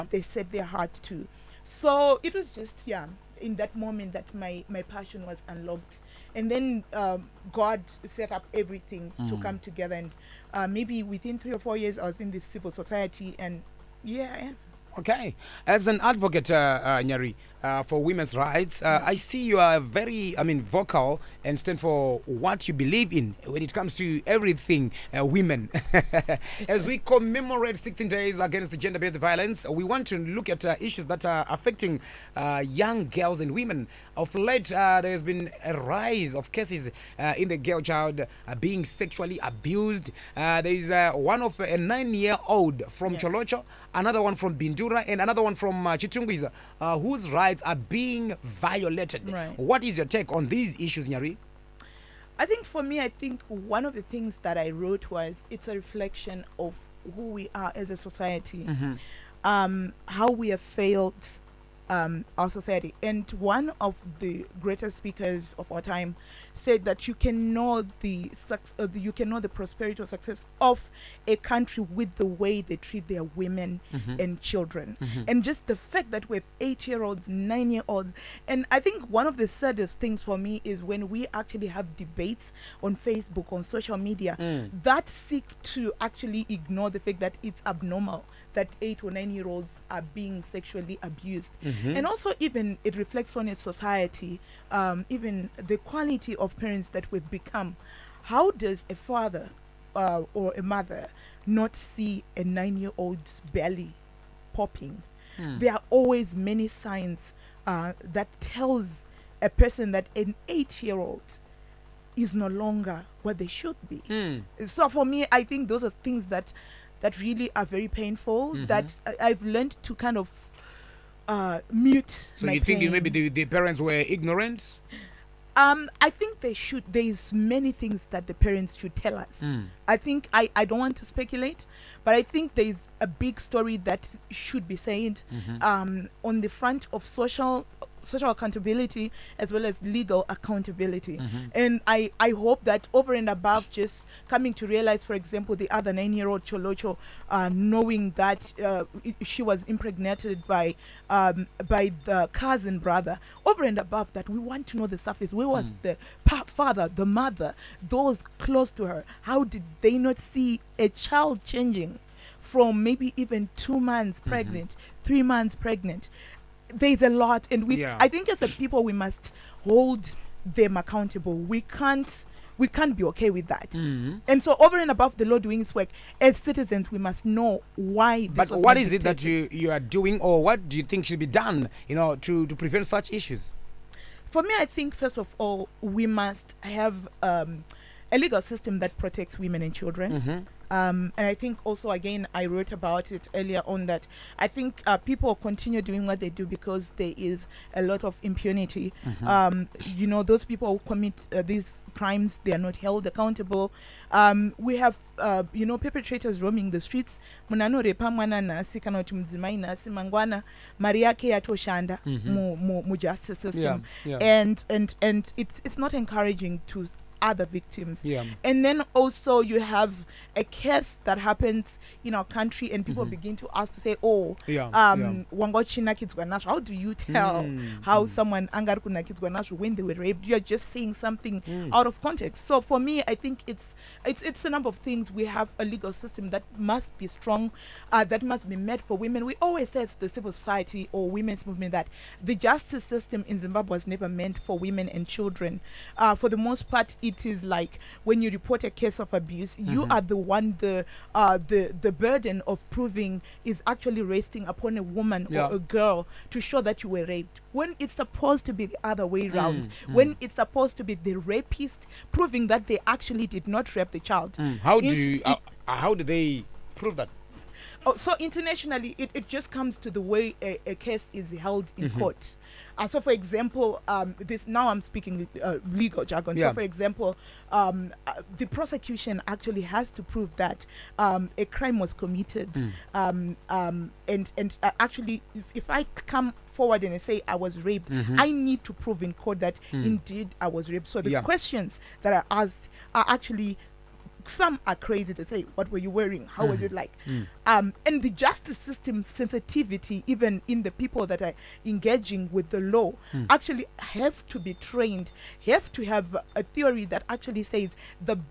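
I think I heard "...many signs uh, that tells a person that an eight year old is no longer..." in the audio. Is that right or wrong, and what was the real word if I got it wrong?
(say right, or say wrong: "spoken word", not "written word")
right.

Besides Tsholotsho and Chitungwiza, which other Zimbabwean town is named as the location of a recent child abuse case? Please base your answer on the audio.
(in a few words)
Bindura.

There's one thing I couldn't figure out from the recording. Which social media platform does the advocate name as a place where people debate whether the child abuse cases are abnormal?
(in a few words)
Facebook.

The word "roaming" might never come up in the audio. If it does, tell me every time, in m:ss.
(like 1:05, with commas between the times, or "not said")
3:26.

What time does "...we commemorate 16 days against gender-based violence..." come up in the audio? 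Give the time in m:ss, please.
0:26.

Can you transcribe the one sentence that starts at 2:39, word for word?
How did they not see a child changing?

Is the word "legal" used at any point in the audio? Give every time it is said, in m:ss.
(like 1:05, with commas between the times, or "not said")
2:19, 3:08, 3:55, 4:35.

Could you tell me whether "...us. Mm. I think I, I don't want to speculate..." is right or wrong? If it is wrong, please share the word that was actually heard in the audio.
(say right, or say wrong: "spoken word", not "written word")
right.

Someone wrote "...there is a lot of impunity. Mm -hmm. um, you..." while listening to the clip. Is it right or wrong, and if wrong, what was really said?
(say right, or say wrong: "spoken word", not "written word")
right.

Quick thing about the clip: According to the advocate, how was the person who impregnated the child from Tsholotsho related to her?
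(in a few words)
Cousin brother.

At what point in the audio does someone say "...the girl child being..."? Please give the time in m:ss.
0:37.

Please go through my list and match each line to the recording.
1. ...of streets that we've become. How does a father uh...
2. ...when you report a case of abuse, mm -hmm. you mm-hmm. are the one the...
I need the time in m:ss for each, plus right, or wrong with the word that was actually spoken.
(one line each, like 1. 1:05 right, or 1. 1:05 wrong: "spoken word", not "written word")
1. 1:36 wrong: "parents", not "streets"
2. 4:08 right.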